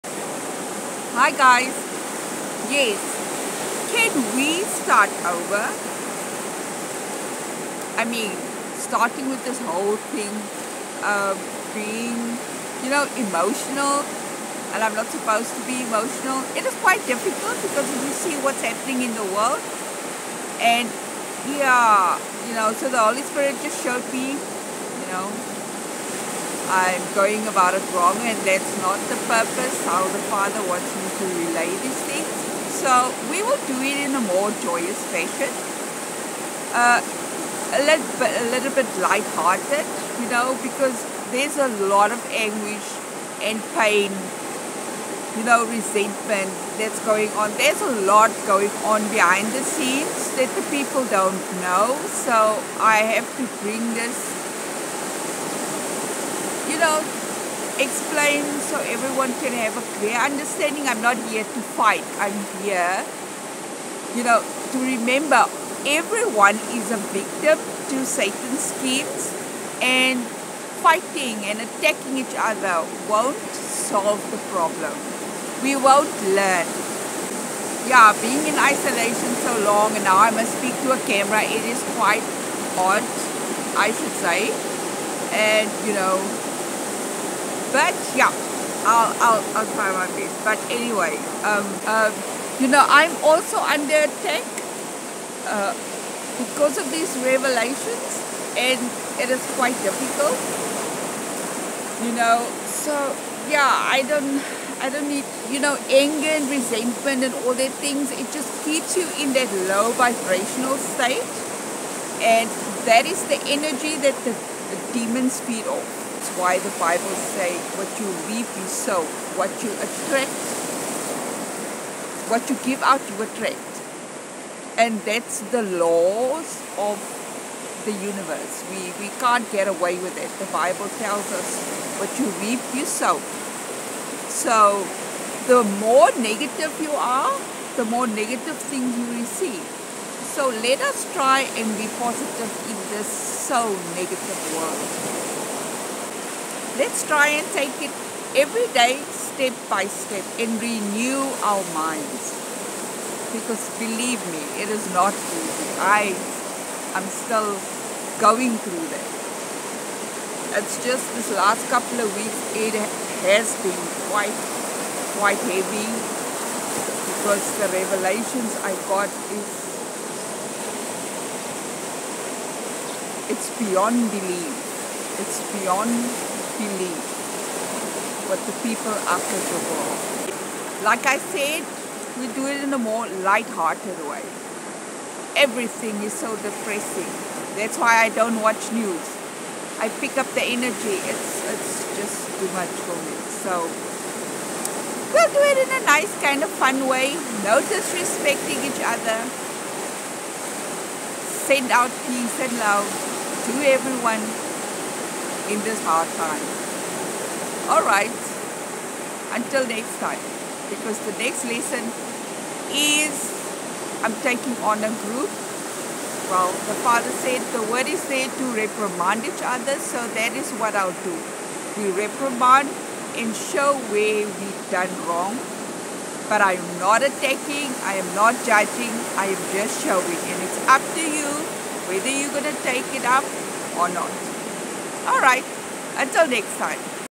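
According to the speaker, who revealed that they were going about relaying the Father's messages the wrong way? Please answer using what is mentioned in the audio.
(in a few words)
The Holy Spirit.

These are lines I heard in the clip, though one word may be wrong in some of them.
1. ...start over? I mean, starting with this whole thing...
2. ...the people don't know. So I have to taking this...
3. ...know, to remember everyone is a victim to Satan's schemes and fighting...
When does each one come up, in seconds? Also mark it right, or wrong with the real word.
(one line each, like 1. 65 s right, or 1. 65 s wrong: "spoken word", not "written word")
1. 4 s right
2. 50 s wrong: "bring", not "taking"
3. 64 s right.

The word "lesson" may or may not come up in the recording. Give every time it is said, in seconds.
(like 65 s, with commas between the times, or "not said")
211 s.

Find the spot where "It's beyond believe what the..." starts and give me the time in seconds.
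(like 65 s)
175 s.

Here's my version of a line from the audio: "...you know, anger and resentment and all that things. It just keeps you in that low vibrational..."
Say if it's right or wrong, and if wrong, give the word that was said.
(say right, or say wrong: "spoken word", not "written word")
right.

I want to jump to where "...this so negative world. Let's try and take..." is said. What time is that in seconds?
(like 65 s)
142 s.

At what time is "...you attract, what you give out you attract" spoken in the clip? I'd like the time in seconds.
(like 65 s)
119 s.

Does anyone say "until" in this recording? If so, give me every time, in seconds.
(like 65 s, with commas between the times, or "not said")
209 s, 235 s.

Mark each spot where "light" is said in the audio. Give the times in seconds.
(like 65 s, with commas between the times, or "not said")
39 s, 183 s.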